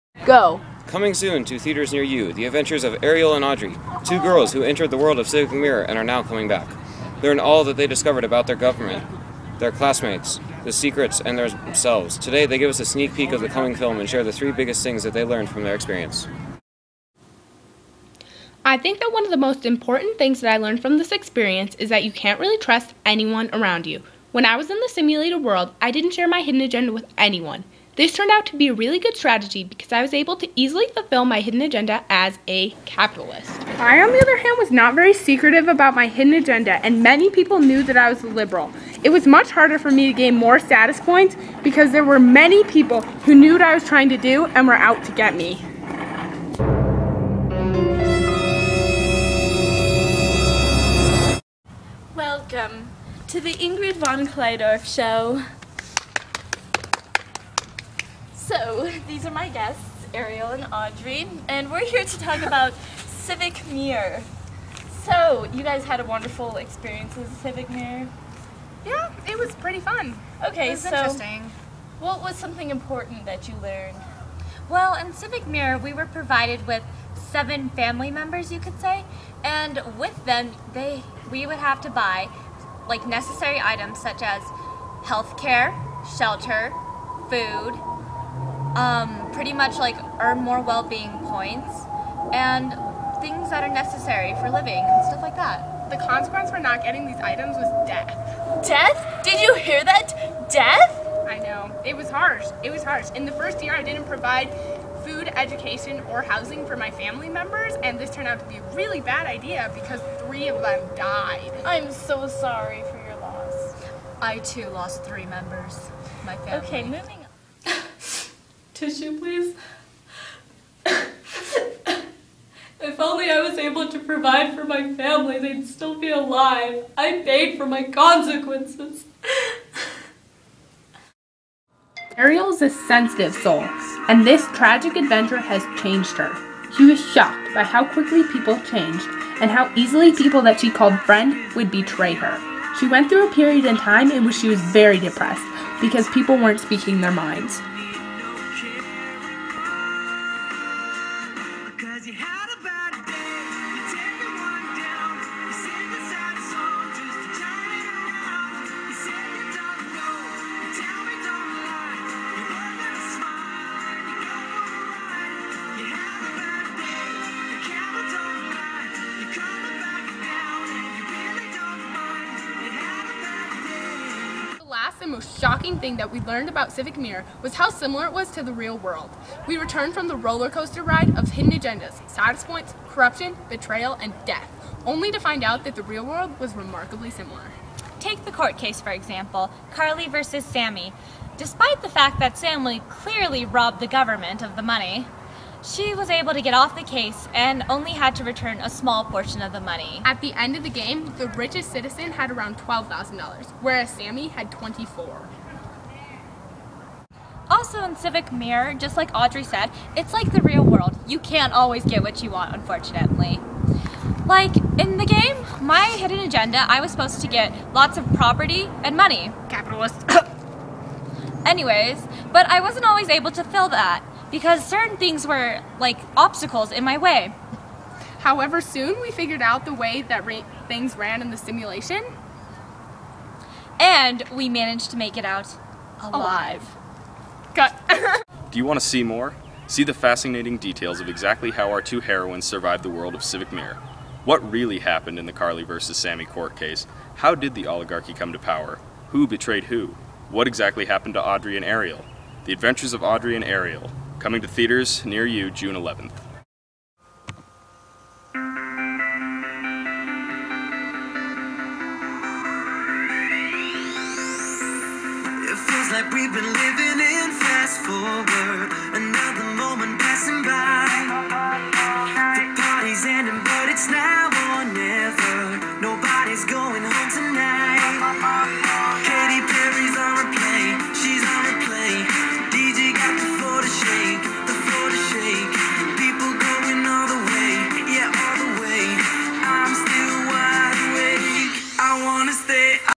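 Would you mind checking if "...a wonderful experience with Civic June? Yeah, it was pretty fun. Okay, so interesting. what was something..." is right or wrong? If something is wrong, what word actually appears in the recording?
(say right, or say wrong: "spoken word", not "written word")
wrong: "Mirror", not "June".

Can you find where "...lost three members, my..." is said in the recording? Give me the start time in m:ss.
1:54.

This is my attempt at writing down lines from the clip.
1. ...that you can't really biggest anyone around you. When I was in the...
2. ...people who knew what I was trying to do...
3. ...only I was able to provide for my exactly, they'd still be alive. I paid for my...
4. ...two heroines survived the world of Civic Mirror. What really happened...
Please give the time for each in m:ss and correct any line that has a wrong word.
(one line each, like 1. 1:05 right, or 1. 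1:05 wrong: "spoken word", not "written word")
1. 0:21 wrong: "trust", not "biggest"
2. 0:42 right
3. 2:02 wrong: "family", not "exactly"
4. 4:01 right.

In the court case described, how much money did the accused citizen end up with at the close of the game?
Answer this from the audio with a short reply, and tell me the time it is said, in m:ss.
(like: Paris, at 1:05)
24, at 3:24.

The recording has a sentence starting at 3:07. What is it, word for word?
Take the court case, for example, Carly versus Sammy.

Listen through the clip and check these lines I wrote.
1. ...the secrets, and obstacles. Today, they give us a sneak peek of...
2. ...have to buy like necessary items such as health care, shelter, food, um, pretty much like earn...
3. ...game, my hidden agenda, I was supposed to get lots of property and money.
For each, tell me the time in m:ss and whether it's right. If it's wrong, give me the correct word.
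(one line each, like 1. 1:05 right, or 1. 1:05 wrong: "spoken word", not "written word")
1. 0:10 wrong: "themselves", not "obstacles"
2. 1:21 right
3. 3:35 right.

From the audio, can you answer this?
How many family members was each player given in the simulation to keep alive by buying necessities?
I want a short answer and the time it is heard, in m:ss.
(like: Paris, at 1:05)
7, at 1:17.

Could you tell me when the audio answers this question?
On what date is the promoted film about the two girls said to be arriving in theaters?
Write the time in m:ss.
4:15.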